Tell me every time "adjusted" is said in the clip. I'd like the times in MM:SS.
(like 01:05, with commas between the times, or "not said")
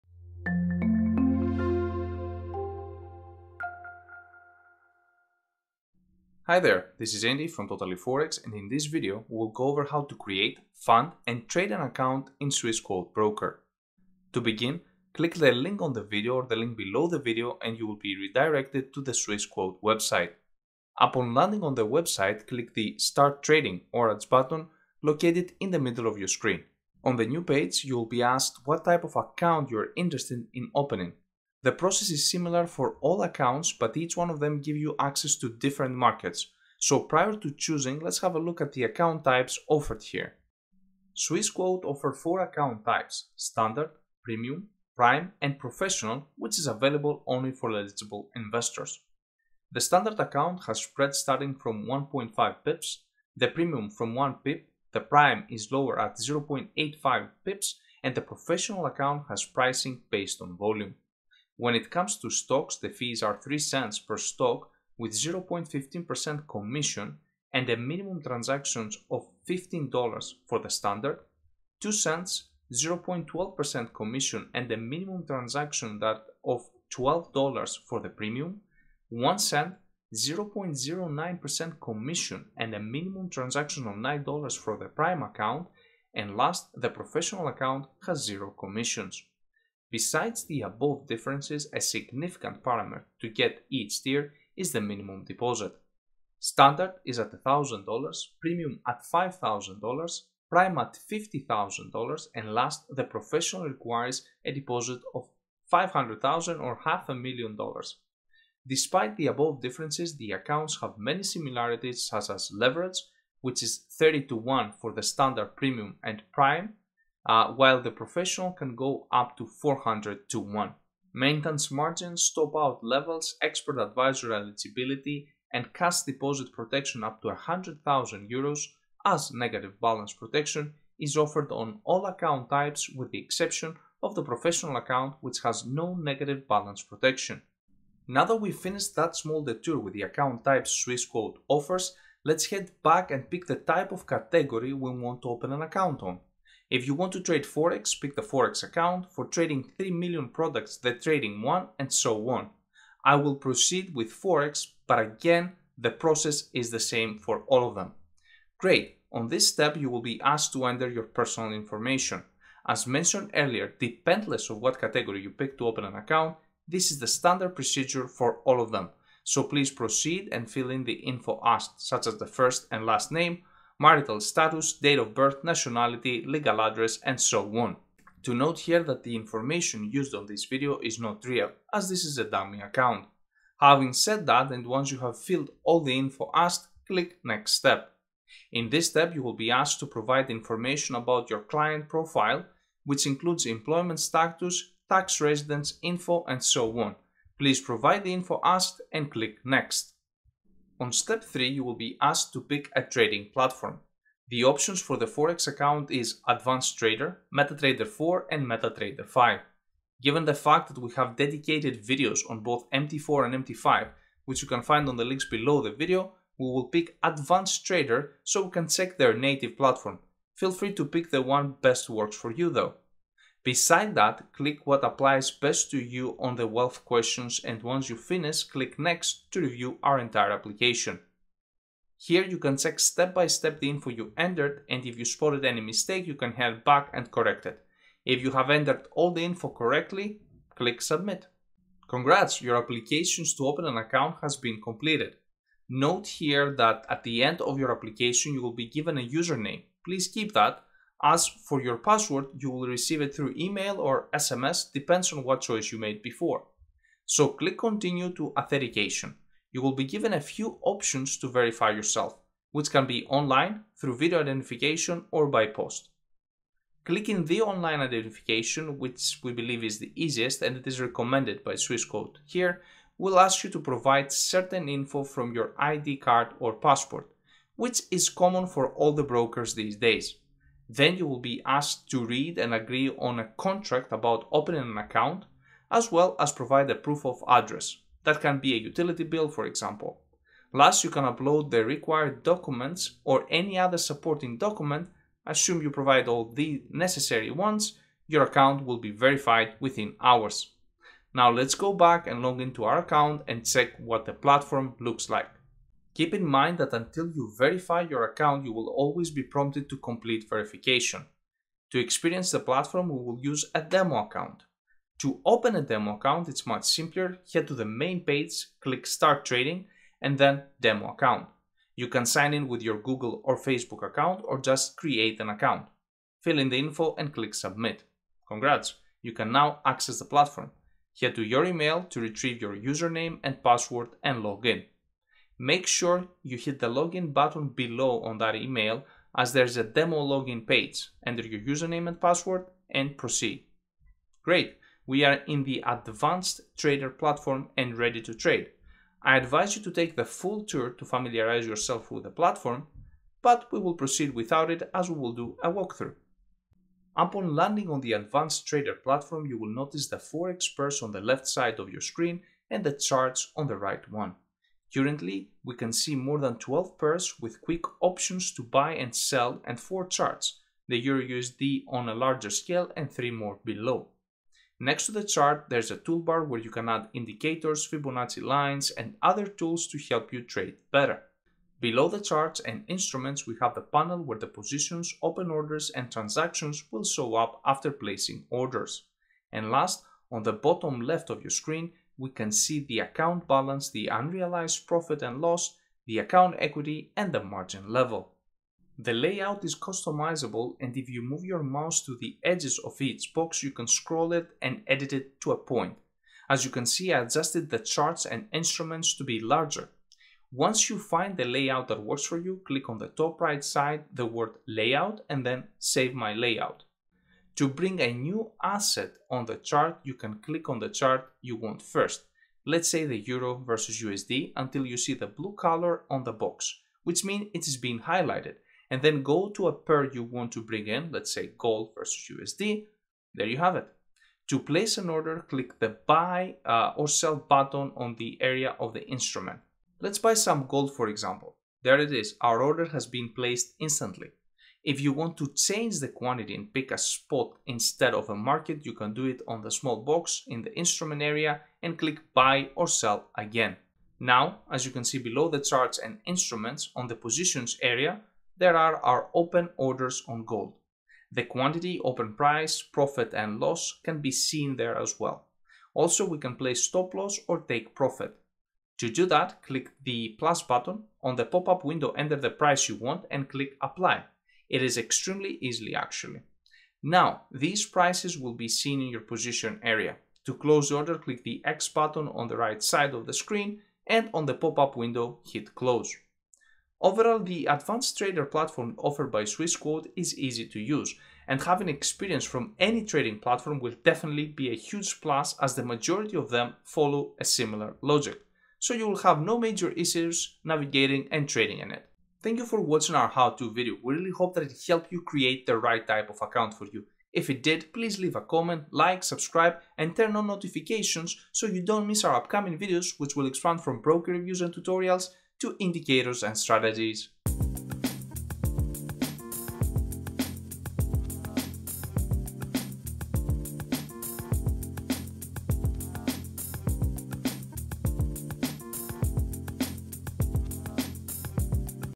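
06:47.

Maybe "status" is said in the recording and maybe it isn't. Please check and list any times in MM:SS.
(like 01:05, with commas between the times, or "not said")
02:54, 03:13.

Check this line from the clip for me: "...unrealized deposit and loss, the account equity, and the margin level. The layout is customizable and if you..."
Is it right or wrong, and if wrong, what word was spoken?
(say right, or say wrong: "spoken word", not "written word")
wrong: "profit", not "deposit".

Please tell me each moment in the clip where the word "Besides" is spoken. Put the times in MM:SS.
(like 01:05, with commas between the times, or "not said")
01:29, 03:43.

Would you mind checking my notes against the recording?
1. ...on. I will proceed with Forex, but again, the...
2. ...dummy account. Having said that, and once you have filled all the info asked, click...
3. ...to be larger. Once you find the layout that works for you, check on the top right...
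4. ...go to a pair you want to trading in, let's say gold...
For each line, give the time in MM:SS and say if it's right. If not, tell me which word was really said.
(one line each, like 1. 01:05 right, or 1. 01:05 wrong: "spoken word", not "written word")
1. 02:32 right
2. 03:02 right
3. 06:48 wrong: "click", not "check"
4. 07:09 wrong: "bring", not "trading".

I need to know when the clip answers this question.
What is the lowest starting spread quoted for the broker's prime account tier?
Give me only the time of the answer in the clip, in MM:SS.
00:56.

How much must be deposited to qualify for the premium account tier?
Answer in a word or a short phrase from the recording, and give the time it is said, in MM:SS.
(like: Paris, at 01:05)
$5,000, at 01:39.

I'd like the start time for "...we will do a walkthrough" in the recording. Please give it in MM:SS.
05:54.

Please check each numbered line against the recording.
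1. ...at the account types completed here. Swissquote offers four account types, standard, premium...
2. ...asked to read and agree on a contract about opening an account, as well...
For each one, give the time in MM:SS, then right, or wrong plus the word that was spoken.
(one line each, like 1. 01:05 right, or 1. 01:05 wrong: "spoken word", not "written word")
1. 00:38 wrong: "offered", not "completed"
2. 04:41 right.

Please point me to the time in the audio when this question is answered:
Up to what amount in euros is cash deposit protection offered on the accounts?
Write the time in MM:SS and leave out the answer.
02:07.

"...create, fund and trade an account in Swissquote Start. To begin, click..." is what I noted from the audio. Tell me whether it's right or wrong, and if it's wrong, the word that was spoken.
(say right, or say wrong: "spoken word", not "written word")
wrong: "Broker", not "Start".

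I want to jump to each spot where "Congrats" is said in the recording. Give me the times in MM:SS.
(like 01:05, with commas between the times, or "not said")
04:01, 05:28.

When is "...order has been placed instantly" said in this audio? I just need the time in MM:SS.
07:22.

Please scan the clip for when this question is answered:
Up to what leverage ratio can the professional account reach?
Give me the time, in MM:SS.
01:59.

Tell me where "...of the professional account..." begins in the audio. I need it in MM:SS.
02:14.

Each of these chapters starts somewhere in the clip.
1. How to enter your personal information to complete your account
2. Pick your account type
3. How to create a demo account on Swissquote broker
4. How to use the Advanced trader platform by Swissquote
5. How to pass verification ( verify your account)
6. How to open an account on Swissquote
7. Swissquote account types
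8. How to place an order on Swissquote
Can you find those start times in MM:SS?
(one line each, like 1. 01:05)
1. 02:40
2. 00:30
3. 05:20
4. 05:45
5. 04:21
6. 00:14
7. 00:40
8. 07:08.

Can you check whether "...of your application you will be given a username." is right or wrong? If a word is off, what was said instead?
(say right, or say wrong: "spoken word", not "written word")
right.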